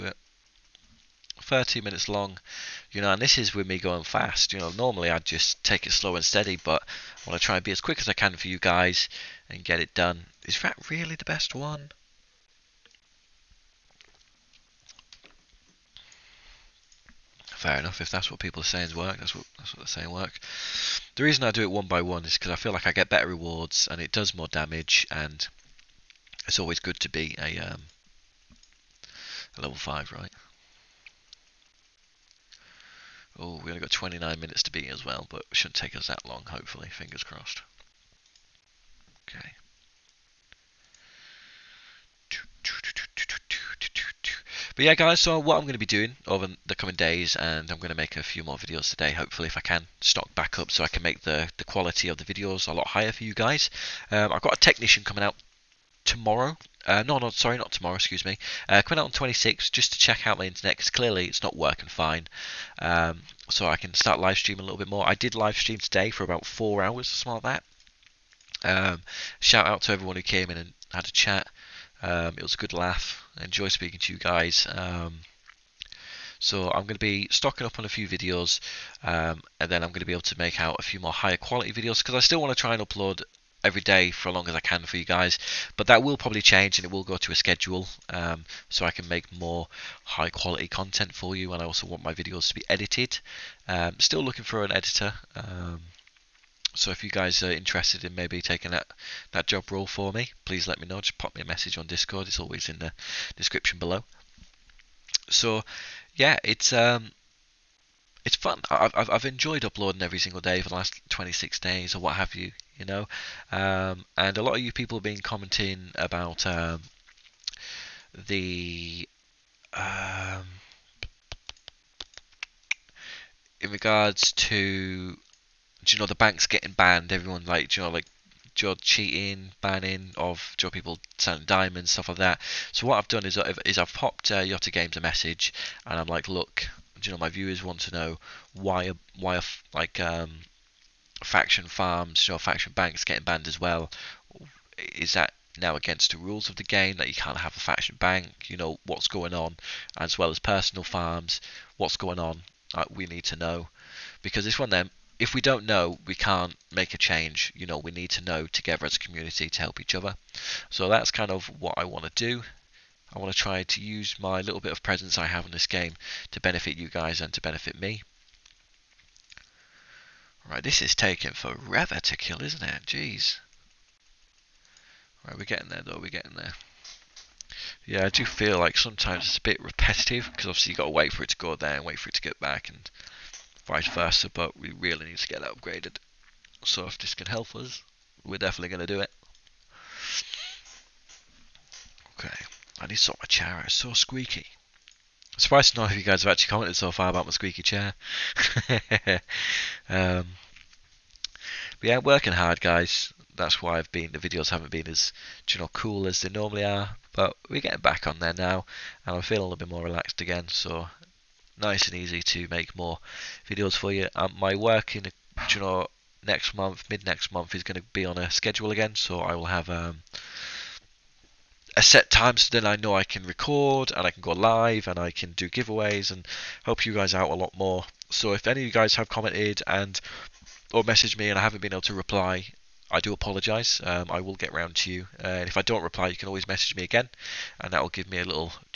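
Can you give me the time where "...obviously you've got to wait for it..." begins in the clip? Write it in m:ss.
3:00.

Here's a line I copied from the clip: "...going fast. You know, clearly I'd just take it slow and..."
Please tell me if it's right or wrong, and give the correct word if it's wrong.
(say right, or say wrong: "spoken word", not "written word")
wrong: "normally", not "clearly".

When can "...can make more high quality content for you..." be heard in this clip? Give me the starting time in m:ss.
1:28.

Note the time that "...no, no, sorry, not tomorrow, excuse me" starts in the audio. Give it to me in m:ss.
0:57.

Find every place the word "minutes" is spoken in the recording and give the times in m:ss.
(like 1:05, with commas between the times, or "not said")
0:01, 0:34.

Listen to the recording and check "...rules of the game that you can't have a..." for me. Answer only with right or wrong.
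right.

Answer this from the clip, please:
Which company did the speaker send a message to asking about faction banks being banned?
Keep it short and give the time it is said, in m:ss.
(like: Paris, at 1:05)
Yotta Games, at 2:14.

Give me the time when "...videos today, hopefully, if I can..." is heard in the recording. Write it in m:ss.
0:48.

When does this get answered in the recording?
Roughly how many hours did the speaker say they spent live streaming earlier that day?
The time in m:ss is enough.
1:06.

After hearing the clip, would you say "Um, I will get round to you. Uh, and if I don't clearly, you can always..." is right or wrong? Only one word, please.
wrong.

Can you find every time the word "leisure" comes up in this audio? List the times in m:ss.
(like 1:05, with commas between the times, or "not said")
not said.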